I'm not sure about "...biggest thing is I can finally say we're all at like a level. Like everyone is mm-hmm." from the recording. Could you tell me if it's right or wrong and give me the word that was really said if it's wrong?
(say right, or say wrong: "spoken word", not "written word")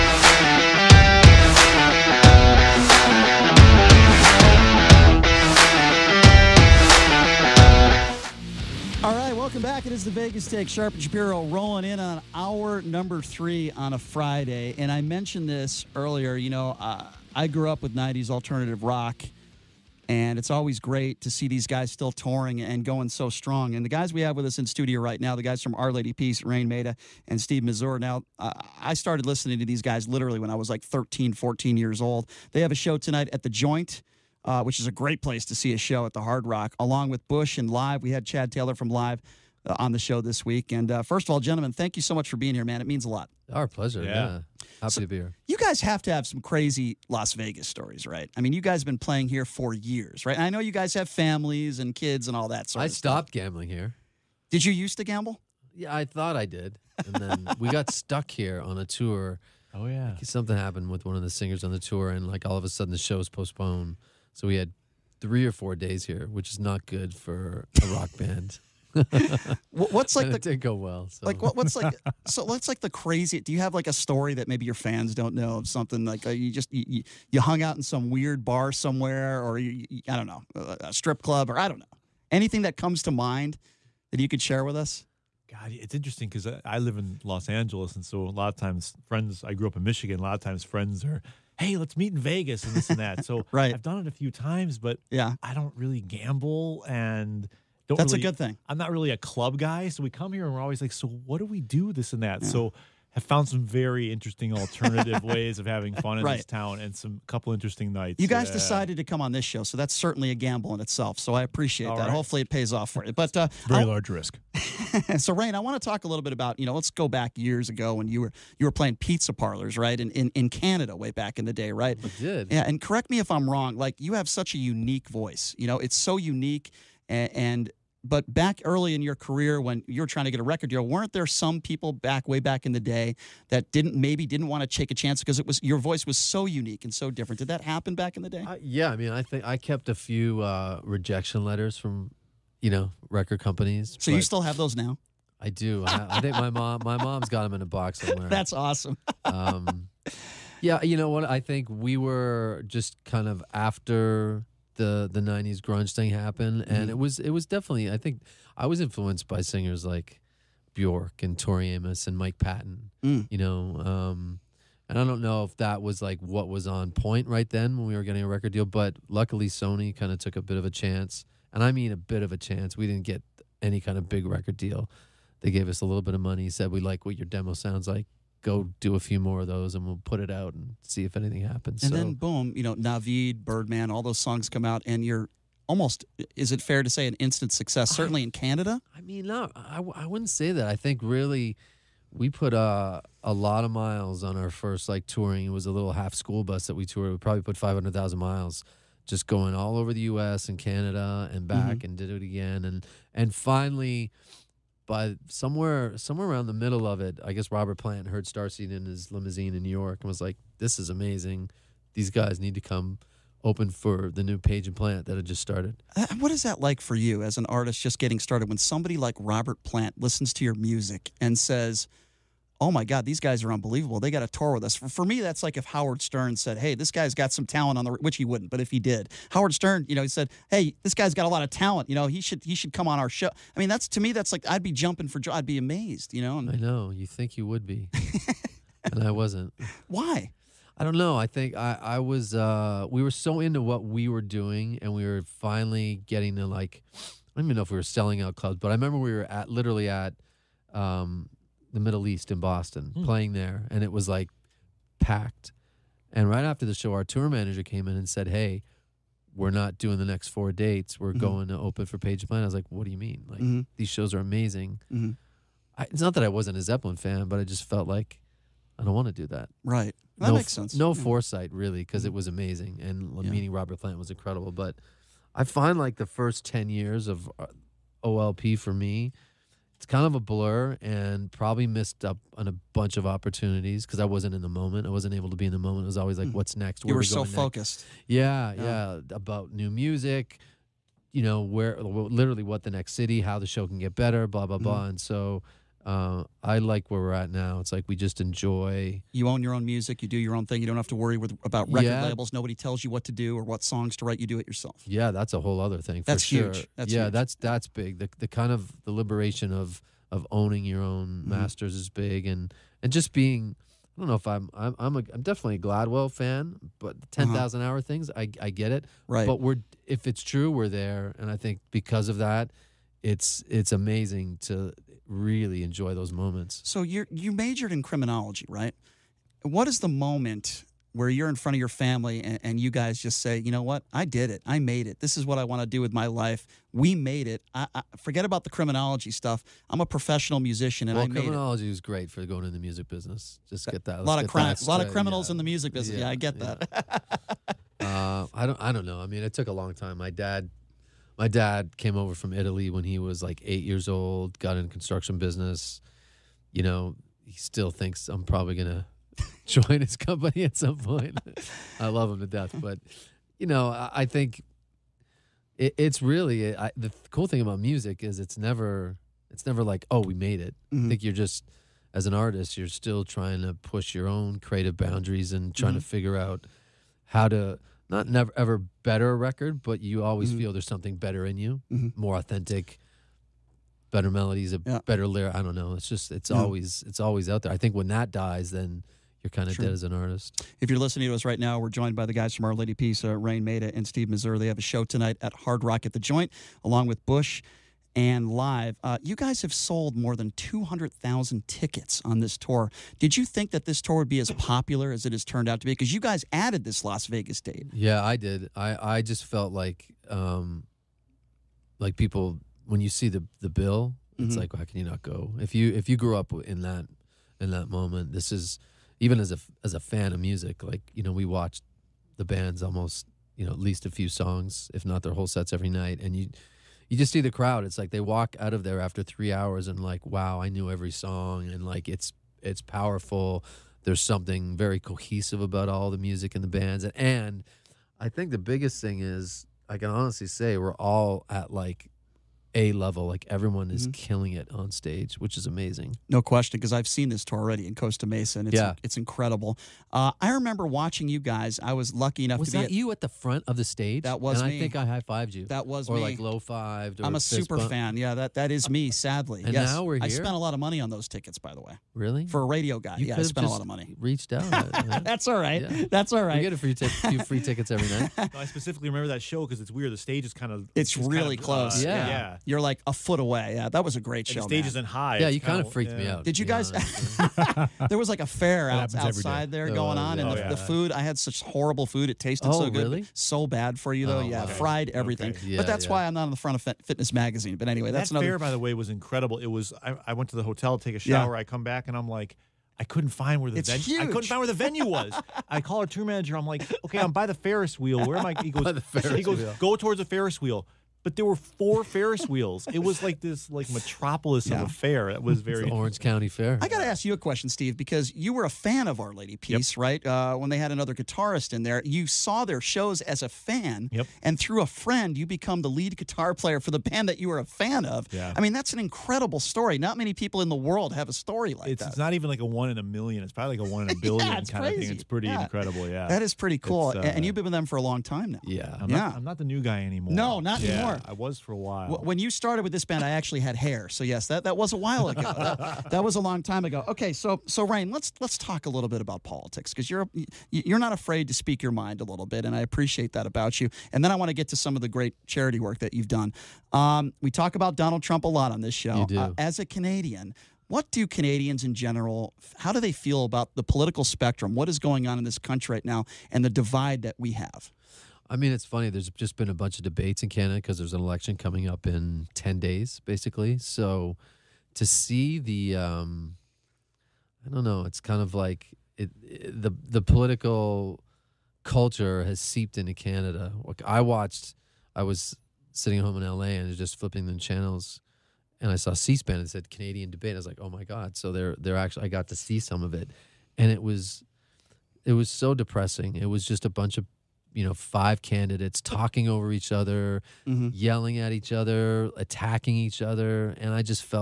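wrong: "honestly", not "finally".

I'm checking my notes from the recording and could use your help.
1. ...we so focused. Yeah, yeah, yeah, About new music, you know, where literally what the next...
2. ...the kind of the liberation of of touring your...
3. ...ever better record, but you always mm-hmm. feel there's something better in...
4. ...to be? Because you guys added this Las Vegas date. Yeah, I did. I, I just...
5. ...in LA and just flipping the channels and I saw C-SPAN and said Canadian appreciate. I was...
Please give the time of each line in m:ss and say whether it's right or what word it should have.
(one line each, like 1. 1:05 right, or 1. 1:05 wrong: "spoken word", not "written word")
1. 4:47 right
2. 5:08 wrong: "owning", not "touring"
3. 6:18 right
4. 6:45 right
5. 9:36 wrong: "debate", not "appreciate".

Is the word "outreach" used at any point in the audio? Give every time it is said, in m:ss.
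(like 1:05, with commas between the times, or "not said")
not said.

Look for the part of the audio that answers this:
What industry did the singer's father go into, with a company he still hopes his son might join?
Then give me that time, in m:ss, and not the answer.
5:54.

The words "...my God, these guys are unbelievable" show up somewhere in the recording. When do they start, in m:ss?
3:42.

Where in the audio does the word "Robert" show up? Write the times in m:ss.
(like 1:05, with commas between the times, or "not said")
3:27, 3:39, 4:33.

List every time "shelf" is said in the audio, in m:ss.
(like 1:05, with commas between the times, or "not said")
not said.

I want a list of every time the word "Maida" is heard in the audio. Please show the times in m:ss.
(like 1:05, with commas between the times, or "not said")
0:26, 6:33.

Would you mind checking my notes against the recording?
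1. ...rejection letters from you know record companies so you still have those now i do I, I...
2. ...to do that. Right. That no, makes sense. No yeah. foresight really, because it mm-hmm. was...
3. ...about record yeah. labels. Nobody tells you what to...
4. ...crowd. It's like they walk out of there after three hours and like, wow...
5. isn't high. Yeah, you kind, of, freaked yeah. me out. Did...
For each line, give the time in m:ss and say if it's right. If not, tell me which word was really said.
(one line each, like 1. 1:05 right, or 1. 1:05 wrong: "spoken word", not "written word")
1. 2:20 right
2. 4:29 right
3. 5:01 right
4. 7:07 right
5. 7:54 right.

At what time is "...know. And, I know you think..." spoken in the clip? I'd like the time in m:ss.
3:56.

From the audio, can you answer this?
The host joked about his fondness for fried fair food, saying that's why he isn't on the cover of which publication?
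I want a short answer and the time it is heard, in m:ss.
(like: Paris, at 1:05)
Fitness Magazine, at 8:06.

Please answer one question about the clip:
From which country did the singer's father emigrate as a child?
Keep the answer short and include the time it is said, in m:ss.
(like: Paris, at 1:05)
Italy, at 5:52.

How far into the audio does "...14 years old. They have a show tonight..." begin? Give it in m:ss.
0:31.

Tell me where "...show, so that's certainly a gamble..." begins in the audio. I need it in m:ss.
1:49.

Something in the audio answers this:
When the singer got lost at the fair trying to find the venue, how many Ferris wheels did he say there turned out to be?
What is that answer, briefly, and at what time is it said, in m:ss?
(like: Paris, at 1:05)
4, at 8:21.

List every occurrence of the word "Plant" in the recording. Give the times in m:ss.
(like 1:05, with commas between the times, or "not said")
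3:27, 3:34, 3:39, 4:22, 4:33.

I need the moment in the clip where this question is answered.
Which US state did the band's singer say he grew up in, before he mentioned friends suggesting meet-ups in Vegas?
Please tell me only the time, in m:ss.
1:29.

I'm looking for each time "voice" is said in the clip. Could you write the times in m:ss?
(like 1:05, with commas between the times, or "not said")
2:05, 2:15.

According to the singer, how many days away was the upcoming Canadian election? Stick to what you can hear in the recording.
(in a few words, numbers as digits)
10 days.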